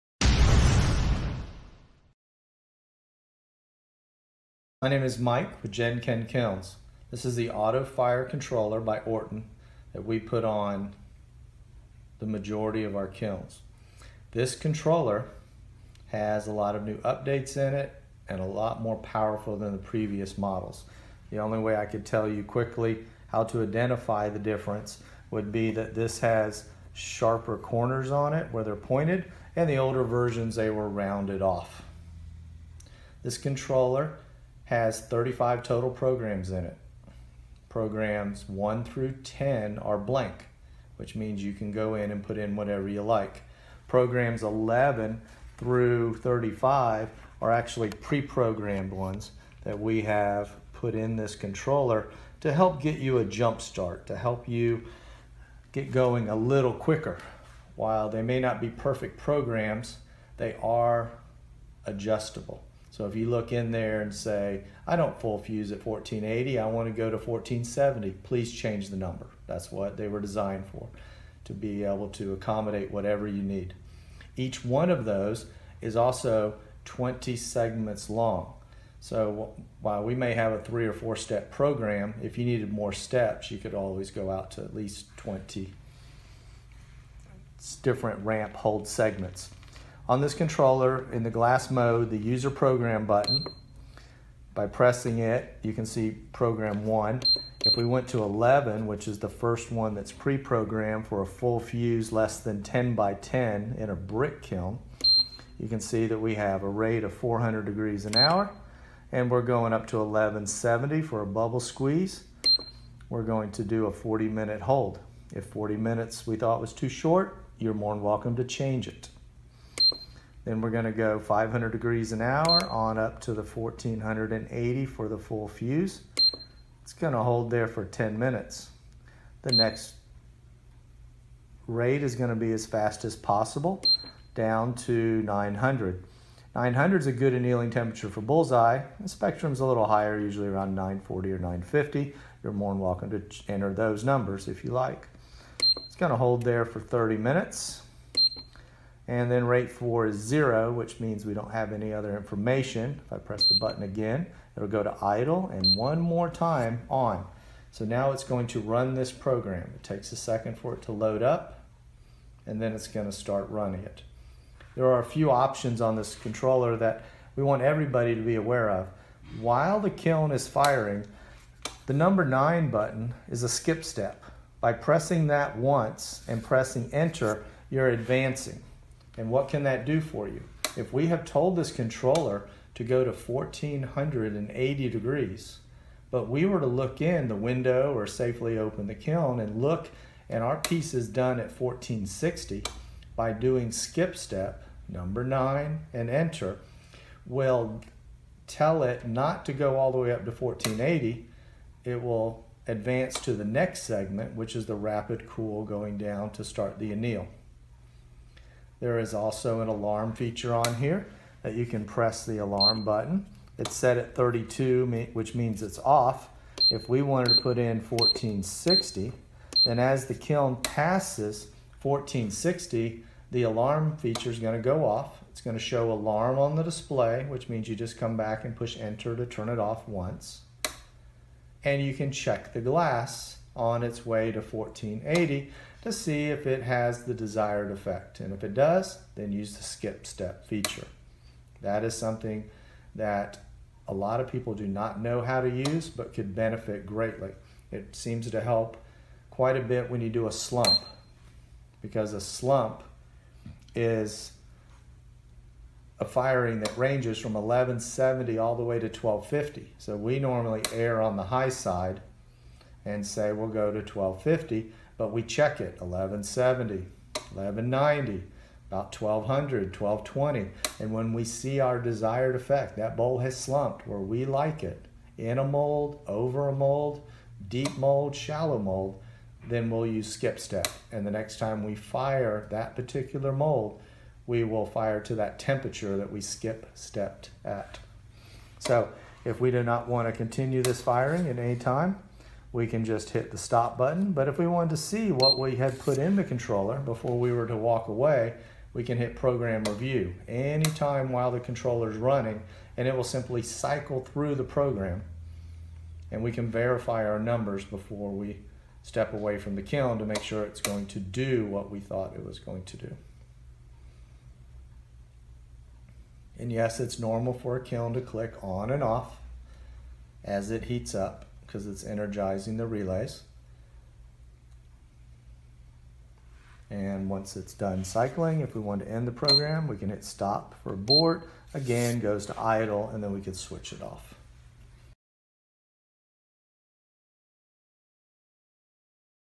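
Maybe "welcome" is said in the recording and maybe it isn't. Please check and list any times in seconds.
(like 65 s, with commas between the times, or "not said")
118 s, 142 s.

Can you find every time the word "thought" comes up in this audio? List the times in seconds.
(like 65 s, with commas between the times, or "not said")
116 s, 311 s.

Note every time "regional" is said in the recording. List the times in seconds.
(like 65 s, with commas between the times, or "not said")
not said.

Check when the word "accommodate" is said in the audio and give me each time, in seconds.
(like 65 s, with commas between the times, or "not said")
72 s.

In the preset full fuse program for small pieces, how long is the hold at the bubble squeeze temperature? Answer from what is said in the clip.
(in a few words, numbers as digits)
40 minutes.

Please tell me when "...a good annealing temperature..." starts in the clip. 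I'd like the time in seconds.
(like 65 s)
137 s.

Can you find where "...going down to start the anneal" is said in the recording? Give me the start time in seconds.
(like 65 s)
205 s.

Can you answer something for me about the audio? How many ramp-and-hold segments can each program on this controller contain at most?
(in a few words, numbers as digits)
20.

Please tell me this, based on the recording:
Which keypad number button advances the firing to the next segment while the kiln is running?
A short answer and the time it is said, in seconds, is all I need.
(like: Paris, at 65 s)
9, at 171 s.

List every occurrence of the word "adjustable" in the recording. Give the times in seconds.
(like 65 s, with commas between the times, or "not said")
61 s.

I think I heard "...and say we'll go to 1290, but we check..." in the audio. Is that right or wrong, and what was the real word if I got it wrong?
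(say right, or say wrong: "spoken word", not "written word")
wrong: "1250", not "1290".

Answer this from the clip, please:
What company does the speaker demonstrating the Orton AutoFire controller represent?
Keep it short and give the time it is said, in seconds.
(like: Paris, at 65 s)
Jen-Ken Kilns, at 5 s.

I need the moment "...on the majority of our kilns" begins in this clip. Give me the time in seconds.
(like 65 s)
10 s.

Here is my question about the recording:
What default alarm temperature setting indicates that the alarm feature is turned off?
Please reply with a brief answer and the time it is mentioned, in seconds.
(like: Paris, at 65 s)
32, at 214 s.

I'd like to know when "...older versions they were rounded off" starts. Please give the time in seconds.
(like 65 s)
29 s.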